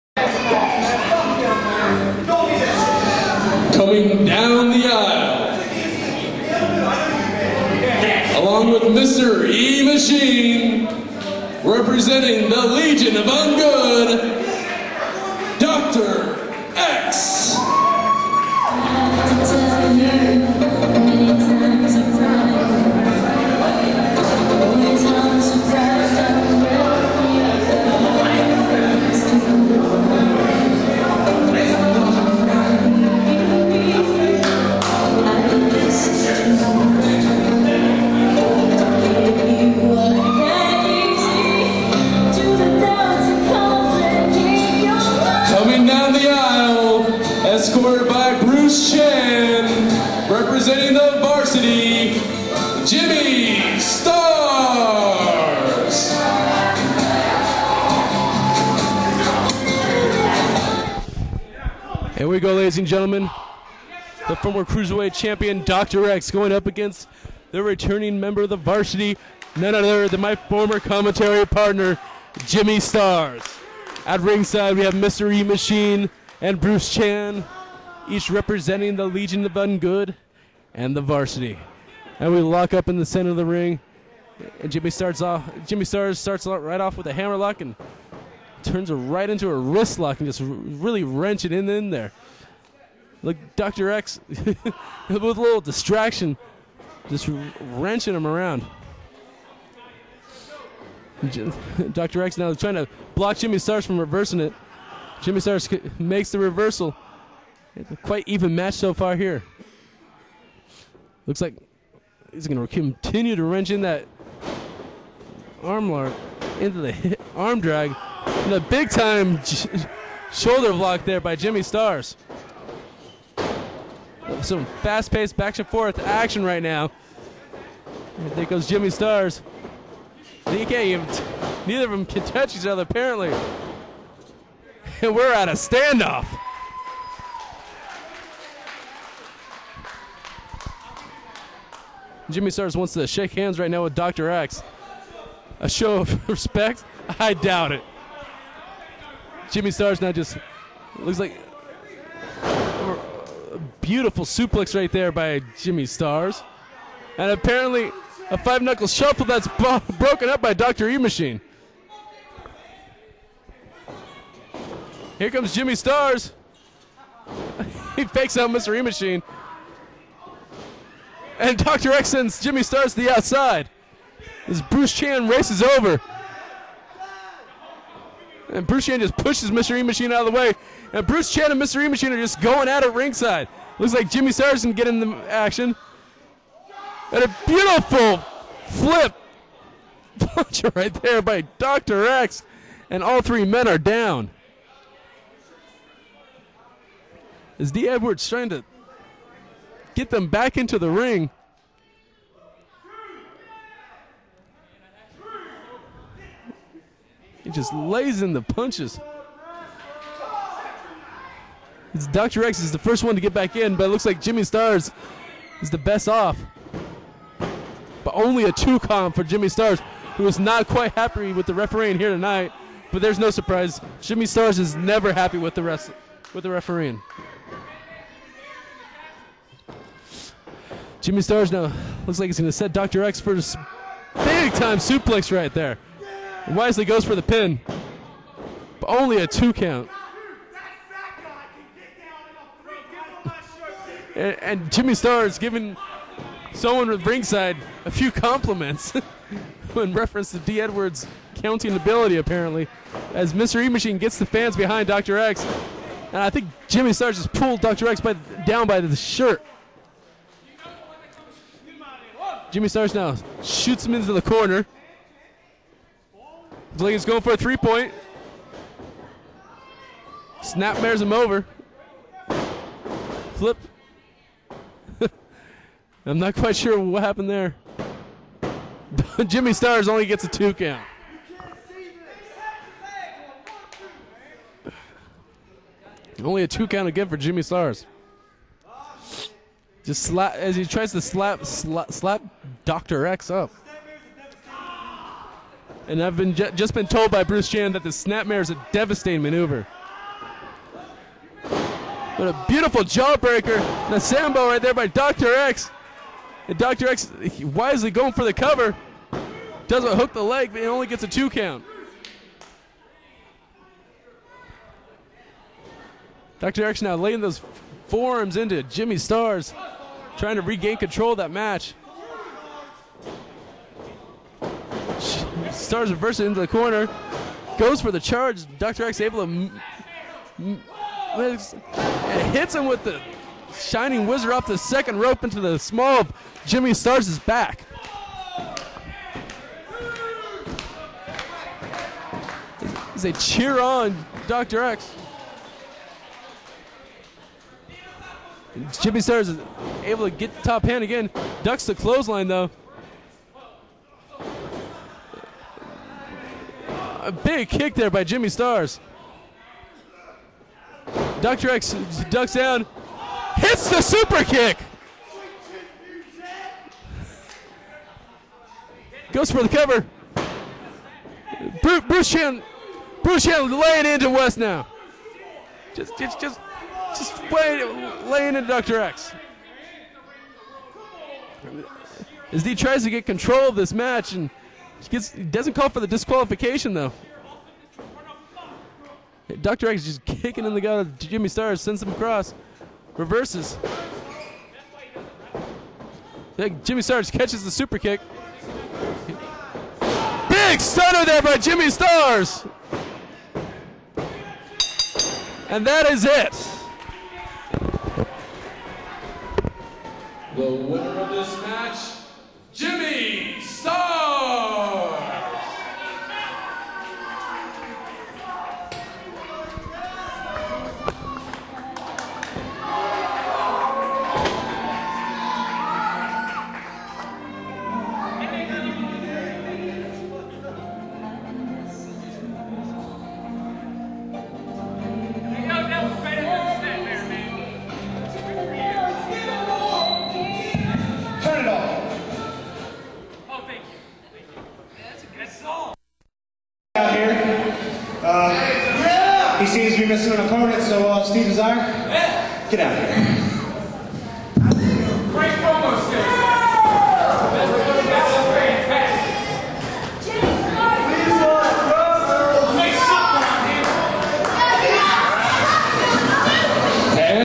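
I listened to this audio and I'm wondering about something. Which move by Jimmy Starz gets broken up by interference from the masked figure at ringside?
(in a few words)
five knuckle shuffle.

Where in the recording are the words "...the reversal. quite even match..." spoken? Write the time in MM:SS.
01:46.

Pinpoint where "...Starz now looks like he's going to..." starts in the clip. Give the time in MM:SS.
03:51.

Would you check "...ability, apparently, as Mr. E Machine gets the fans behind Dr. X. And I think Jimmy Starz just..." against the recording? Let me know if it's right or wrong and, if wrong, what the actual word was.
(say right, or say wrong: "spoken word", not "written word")
right.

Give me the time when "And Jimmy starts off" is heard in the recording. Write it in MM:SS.
01:24.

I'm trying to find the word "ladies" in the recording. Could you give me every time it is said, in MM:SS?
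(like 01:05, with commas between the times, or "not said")
01:02.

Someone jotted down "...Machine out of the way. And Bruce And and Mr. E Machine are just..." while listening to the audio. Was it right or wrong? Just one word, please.
wrong.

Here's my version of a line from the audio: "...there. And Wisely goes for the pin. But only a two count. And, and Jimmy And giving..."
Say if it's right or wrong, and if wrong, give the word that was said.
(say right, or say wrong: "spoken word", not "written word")
wrong: "Starz", not "And".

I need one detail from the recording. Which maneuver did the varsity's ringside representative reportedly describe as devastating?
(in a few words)
snapmare.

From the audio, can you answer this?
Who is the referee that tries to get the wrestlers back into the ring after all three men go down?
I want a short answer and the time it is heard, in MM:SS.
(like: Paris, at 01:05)
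D. Edwards, at 03:17.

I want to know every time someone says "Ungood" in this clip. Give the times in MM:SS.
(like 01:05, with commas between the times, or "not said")
00:13, 01:19.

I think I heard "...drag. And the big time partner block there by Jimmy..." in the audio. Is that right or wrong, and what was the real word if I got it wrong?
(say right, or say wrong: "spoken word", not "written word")
wrong: "shoulder", not "partner".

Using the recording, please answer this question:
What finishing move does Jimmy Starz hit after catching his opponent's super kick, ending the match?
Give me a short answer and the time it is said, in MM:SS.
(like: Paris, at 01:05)
stunner, at 06:40.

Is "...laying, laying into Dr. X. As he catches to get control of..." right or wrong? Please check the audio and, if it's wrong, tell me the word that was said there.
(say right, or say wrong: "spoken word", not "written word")
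wrong: "tries", not "catches".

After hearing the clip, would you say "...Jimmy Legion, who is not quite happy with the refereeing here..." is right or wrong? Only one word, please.
wrong.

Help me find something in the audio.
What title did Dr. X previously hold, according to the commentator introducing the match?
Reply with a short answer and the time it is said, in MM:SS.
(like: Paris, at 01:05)
Cruiserweight champion, at 01:04.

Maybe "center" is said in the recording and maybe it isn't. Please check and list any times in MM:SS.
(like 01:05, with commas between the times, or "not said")
01:23.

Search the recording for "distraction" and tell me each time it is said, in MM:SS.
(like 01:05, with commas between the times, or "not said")
01:35.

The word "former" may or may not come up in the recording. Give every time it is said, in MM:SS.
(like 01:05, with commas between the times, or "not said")
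01:04, 01:10.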